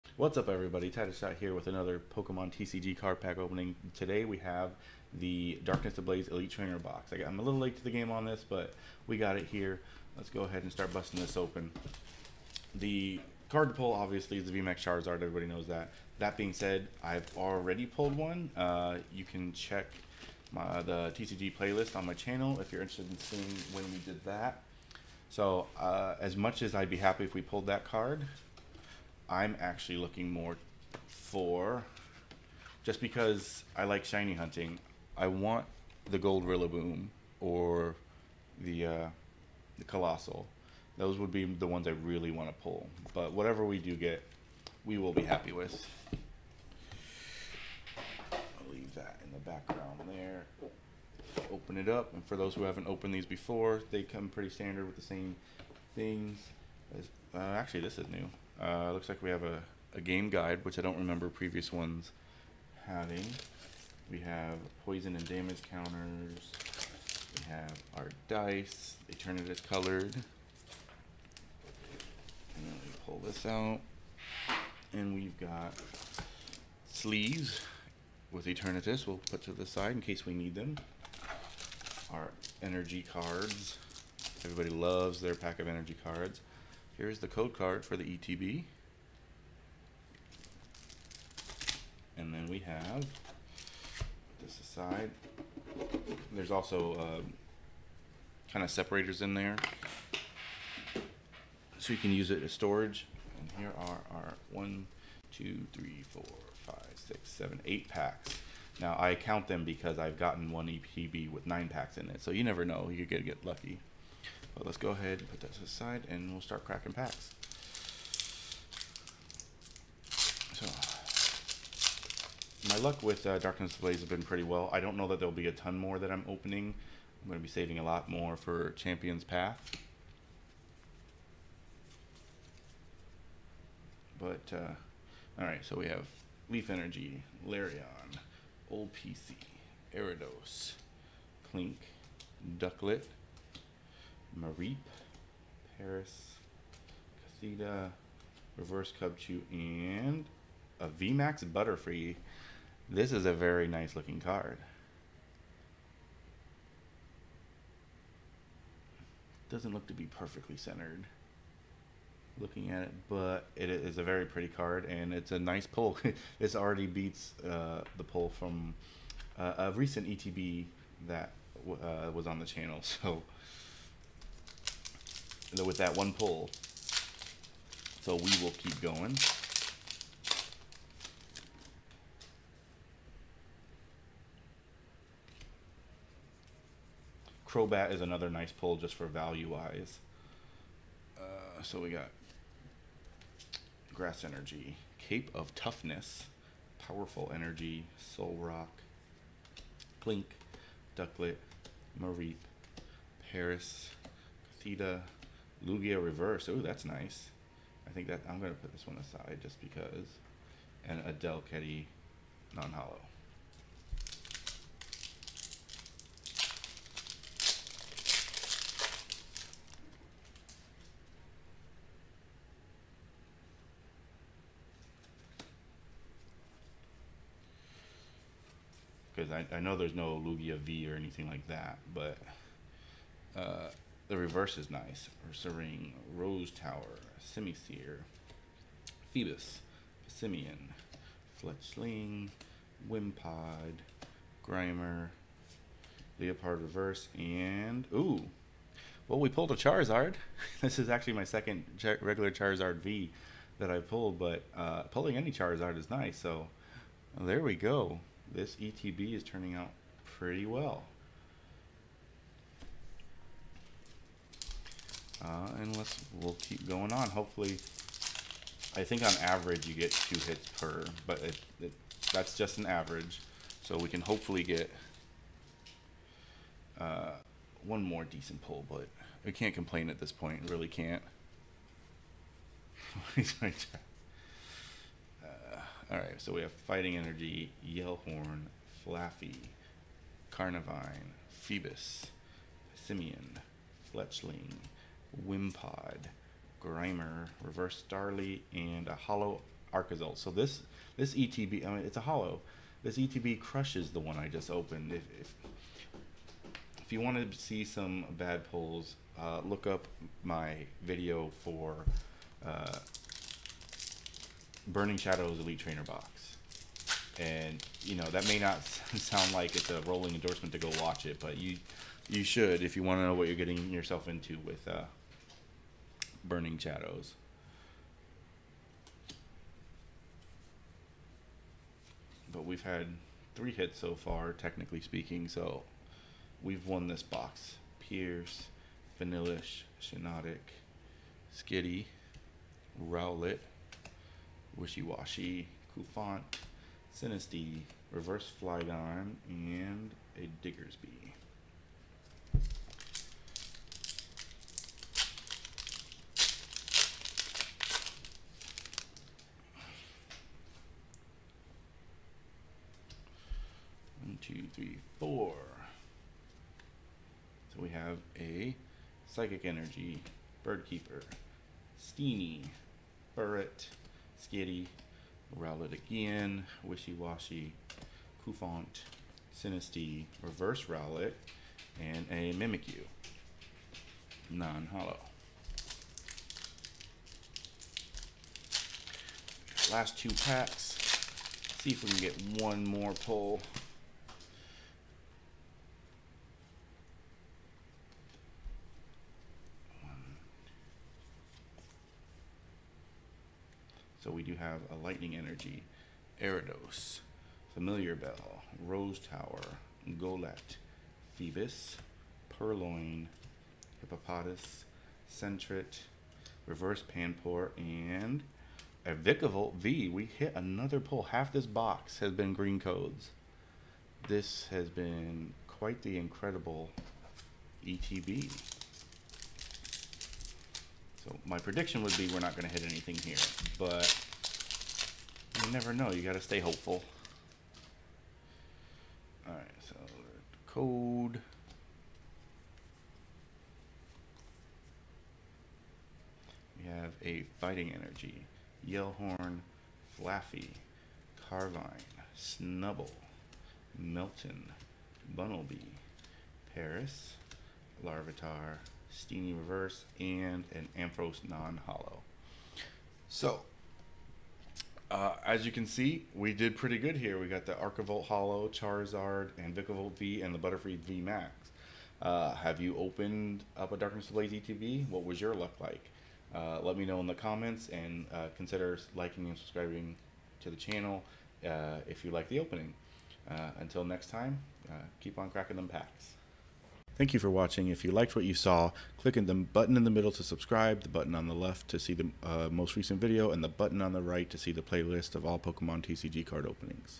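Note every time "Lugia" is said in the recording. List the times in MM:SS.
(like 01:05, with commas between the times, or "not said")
03:25, 03:50.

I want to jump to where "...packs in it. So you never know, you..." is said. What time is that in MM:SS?
01:51.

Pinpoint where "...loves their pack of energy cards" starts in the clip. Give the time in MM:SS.
01:24.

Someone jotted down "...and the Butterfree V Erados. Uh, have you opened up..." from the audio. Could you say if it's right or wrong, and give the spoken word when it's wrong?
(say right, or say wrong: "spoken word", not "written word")
wrong: "Max", not "Erados".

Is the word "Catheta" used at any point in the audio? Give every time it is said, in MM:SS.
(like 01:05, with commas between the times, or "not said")
02:27, 03:24.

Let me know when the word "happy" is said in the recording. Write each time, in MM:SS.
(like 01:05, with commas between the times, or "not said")
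00:26, 00:45.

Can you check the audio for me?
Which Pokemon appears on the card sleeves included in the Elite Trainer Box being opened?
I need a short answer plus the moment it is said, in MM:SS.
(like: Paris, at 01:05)
Eternatus, at 01:18.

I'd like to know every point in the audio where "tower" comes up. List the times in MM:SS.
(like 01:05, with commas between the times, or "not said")
03:56, 06:48.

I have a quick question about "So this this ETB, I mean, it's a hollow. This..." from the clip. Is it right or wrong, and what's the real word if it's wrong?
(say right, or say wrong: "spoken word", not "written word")
right.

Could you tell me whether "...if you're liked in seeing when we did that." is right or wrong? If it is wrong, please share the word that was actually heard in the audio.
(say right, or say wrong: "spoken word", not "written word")
wrong: "interested", not "liked".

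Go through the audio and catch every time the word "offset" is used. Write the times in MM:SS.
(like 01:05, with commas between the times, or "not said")
not said.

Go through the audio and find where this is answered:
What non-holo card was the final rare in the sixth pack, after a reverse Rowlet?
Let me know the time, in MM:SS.
06:22.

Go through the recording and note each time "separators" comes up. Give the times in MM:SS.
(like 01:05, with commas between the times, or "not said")
01:38.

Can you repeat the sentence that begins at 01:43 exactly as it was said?
And here are our one, two, three, four, five, six, seven, eight packs.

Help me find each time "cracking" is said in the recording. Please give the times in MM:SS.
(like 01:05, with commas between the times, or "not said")
01:56, 08:05.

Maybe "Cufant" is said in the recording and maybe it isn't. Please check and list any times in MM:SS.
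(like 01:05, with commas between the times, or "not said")
05:45, 06:18.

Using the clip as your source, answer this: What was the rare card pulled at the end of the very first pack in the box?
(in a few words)
VMAX Butterfree.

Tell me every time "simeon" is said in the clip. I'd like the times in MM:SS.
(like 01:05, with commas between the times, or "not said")
04:00, 04:52.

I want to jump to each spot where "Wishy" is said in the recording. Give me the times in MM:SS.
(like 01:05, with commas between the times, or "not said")
05:44, 06:16.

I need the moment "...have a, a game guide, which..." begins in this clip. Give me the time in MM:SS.
00:59.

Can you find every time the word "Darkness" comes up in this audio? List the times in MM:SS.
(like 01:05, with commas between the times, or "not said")
00:05, 02:03, 07:53.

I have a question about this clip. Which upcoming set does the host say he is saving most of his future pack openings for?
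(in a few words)
Champion's Path.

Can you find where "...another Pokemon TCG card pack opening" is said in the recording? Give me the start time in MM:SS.
00:01.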